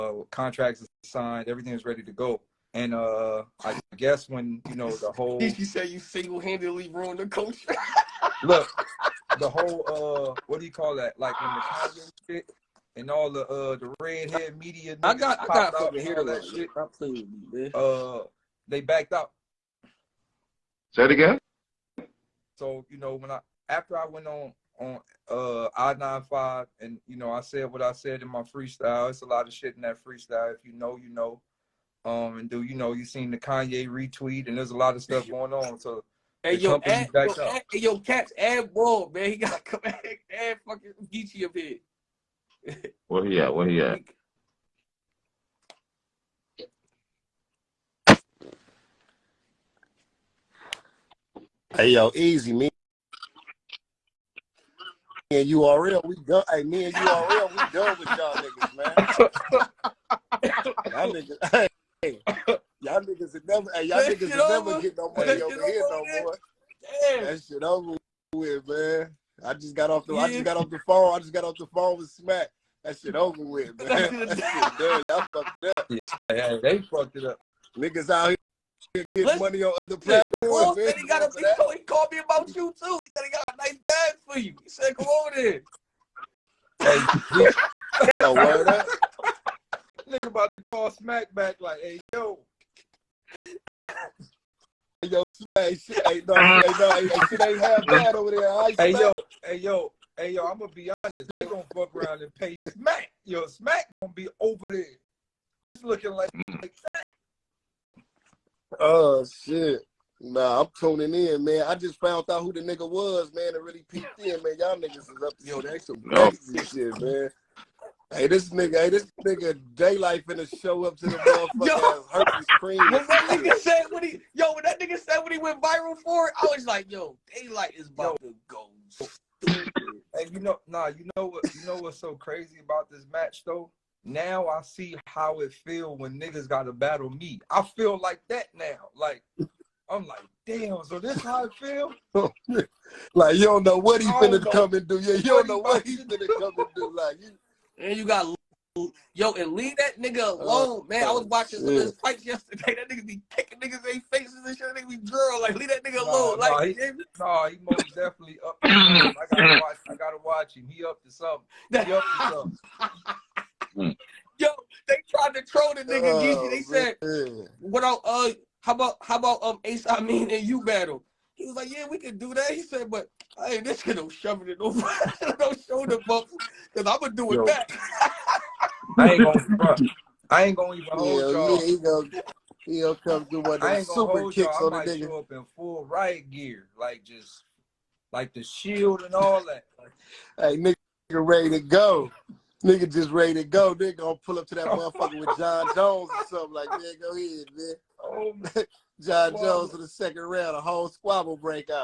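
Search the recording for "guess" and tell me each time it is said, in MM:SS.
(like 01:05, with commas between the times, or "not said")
00:03.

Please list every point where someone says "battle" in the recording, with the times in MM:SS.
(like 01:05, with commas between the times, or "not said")
02:16, 02:50.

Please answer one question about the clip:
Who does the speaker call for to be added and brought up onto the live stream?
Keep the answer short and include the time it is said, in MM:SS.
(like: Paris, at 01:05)
Geechi, at 00:41.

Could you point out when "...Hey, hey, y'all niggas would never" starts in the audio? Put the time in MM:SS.
01:02.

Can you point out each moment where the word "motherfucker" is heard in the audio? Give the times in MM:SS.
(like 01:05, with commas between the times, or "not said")
02:01, 03:14.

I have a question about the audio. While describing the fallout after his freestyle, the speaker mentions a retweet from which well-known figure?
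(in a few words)
Kanye.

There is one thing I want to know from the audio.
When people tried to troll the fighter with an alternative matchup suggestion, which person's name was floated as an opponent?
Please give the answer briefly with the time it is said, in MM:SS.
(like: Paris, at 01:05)
Ace, at 02:49.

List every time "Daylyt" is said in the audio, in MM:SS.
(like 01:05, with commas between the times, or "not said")
01:59, 02:07.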